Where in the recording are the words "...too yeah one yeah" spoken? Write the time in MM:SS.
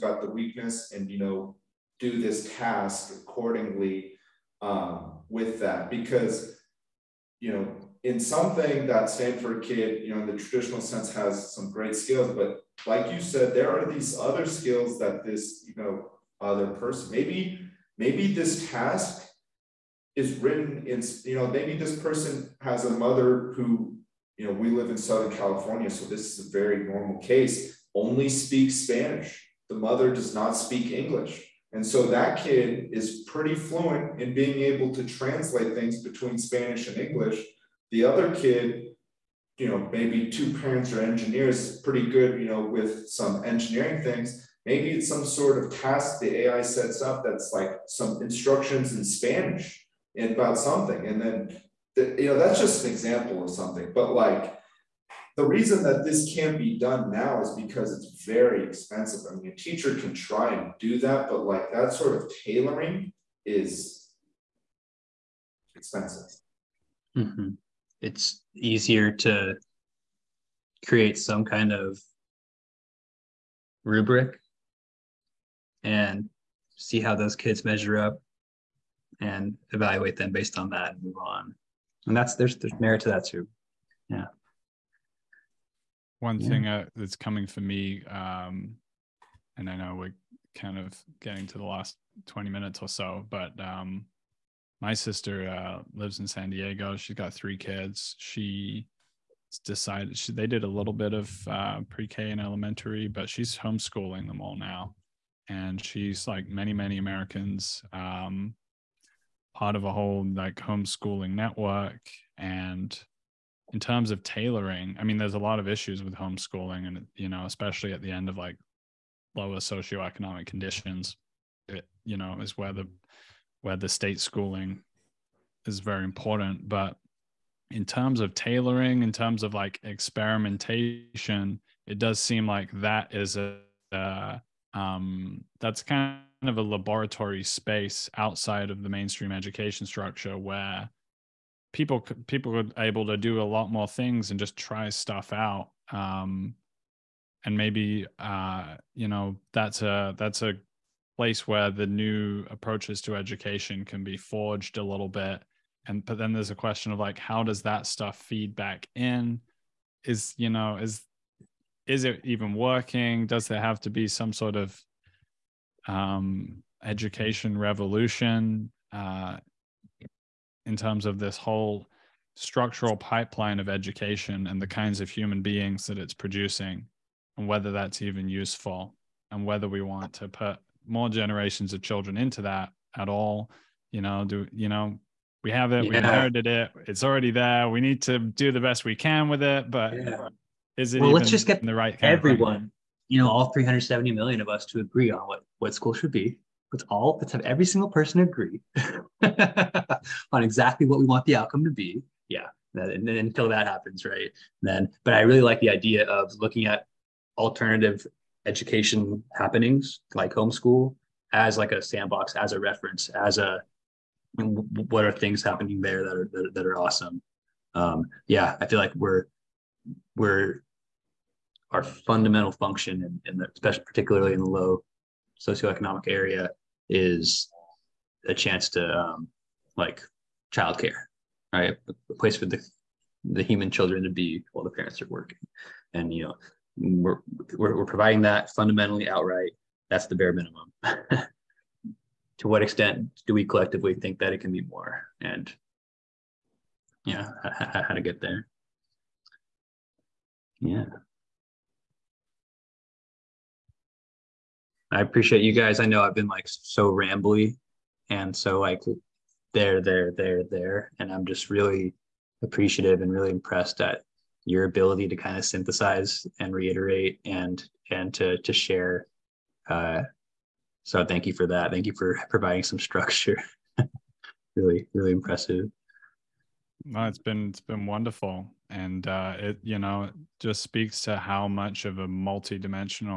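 01:23.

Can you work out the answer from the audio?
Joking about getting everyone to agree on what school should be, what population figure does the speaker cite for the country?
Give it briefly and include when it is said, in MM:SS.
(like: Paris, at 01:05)
370 million, at 03:13.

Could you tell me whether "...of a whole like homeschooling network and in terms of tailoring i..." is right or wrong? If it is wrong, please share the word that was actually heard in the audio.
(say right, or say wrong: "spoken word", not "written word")
right.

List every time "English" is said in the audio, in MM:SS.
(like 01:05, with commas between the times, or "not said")
00:30, 00:36.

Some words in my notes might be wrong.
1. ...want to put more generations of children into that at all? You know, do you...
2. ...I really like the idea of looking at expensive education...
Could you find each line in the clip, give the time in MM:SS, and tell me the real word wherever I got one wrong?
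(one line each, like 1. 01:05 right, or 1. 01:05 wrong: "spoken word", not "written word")
1. 02:59 right
2. 03:25 wrong: "alternative", not "expensive".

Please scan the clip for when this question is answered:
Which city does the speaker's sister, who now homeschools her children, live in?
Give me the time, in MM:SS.
01:36.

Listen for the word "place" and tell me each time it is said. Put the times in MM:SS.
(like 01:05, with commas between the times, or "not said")
02:31, 03:52.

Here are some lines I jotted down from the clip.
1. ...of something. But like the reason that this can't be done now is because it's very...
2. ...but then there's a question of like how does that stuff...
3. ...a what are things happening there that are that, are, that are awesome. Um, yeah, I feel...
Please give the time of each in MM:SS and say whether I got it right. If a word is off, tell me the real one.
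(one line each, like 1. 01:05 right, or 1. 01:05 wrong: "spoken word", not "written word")
1. 00:53 right
2. 02:36 right
3. 03:33 right.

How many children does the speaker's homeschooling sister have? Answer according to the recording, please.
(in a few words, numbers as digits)
3.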